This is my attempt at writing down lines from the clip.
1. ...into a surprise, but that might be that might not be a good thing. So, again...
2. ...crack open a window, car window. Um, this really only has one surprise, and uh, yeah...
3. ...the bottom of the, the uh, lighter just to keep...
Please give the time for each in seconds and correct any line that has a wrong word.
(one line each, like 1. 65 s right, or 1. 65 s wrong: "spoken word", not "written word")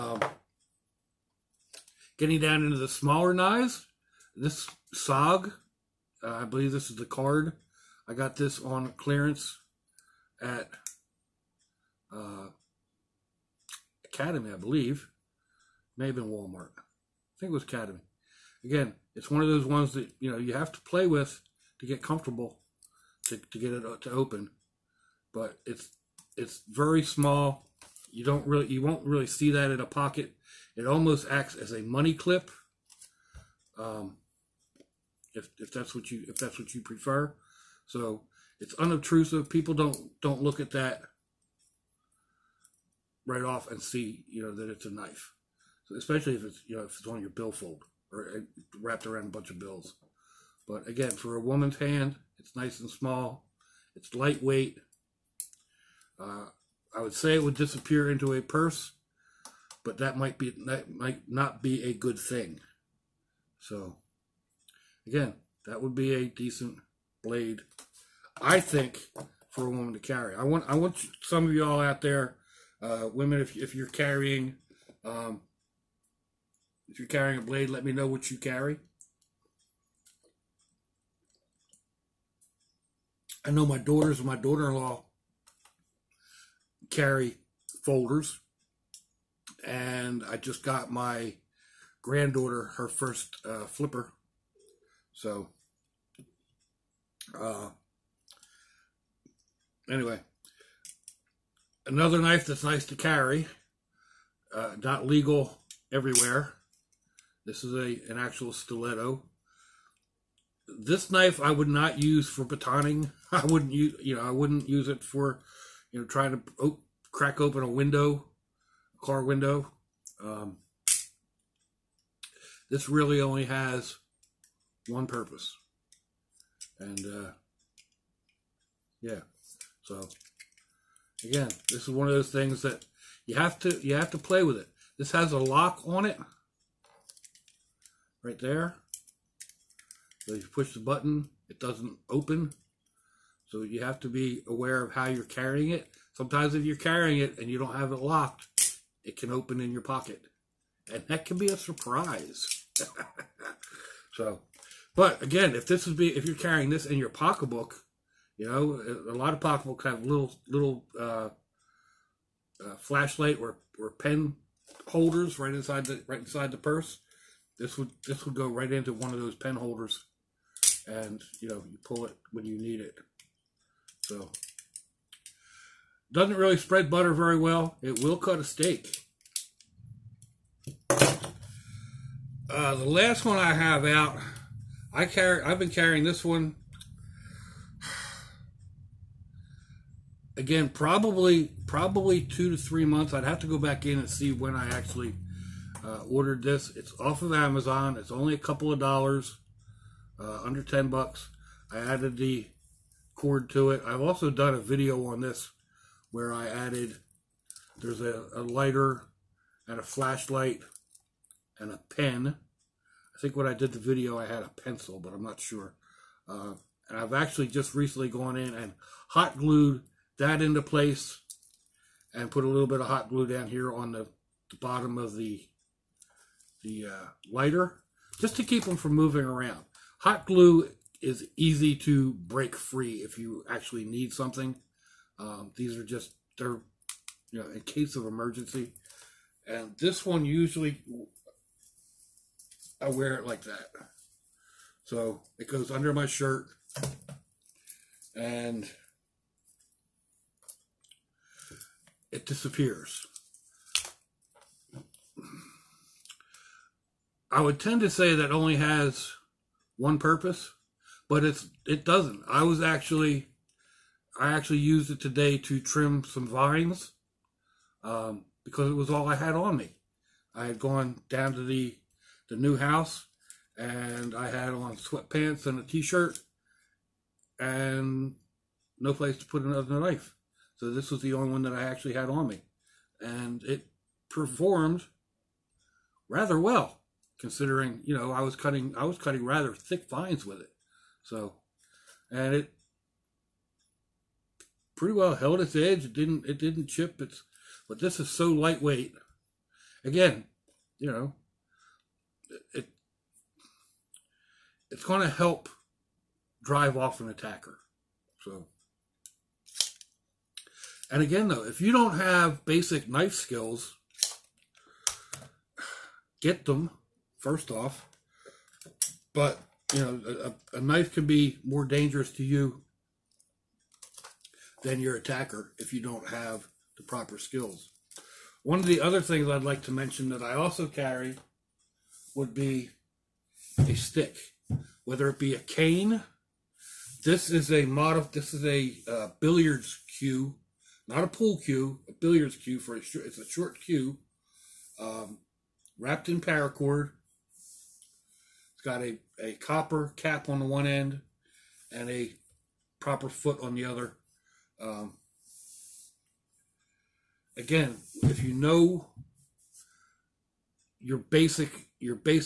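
1. 58 s wrong: "purse", not "surprise"
2. 117 s wrong: "purpose", not "surprise"
3. 224 s right.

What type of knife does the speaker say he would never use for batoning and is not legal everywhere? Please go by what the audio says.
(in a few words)
stiletto.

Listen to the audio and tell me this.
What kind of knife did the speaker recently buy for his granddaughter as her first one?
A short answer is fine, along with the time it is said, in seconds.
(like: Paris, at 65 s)
flipper, at 93 s.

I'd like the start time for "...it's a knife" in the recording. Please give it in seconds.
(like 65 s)
44 s.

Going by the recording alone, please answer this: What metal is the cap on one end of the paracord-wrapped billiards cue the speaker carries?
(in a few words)
copper.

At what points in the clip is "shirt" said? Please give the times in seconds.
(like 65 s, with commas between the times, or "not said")
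246 s, 275 s.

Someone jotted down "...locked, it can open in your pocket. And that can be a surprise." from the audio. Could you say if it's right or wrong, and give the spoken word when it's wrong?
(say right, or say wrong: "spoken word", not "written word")
right.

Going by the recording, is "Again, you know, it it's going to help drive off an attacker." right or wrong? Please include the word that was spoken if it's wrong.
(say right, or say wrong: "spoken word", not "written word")
right.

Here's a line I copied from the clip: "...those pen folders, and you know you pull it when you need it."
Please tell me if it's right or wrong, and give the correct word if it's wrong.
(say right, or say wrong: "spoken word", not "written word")
wrong: "holders", not "folders".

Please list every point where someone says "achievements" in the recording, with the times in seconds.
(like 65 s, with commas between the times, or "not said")
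not said.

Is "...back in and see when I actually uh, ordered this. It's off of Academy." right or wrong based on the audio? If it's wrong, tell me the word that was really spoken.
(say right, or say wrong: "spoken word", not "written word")
wrong: "Amazon", not "Academy".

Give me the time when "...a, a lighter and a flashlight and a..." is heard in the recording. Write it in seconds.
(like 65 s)
208 s.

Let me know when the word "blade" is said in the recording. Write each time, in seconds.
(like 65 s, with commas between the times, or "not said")
67 s, 77 s.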